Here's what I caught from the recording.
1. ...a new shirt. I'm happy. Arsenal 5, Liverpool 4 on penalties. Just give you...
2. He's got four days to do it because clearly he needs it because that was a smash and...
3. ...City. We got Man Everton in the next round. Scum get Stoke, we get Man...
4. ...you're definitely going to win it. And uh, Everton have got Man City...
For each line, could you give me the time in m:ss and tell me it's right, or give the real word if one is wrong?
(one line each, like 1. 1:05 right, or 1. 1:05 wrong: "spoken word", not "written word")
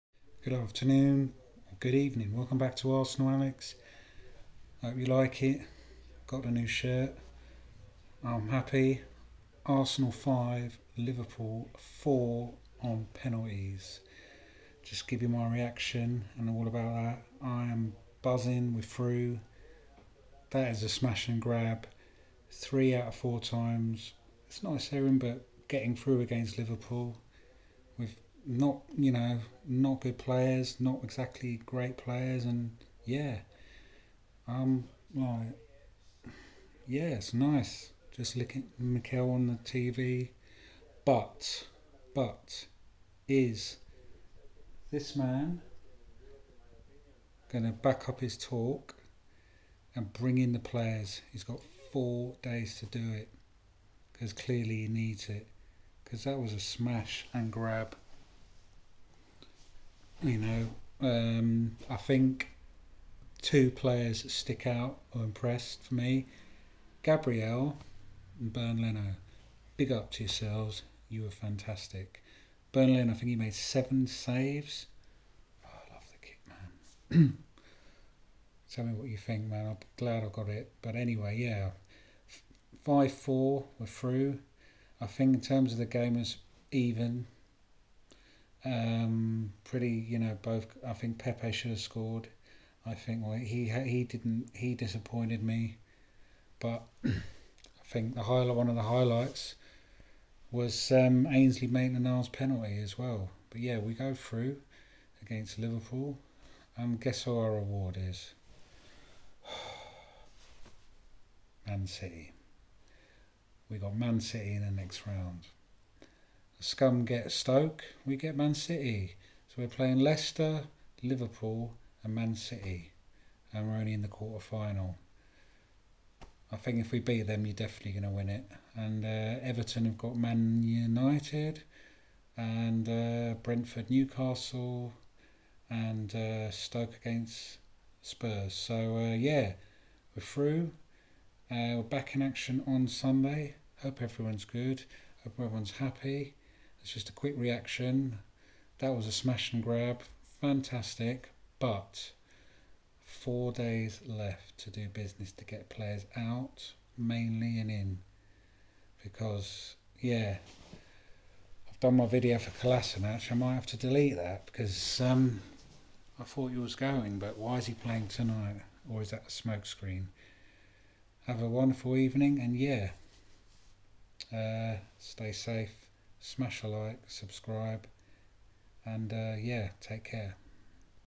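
1. 0:06 right
2. 0:51 right
3. 1:51 wrong: "City", not "Everton"
4. 2:07 wrong: "United", not "City".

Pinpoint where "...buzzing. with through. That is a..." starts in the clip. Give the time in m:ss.
0:18.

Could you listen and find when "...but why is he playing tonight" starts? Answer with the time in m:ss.
2:47.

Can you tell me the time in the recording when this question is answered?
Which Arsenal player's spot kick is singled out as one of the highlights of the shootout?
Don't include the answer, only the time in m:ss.
1:41.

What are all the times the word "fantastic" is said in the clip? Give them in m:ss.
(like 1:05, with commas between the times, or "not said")
1:11, 2:30.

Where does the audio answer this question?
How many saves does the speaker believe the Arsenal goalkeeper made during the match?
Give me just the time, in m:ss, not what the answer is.
1:13.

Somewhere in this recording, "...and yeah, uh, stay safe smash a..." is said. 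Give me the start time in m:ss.
2:52.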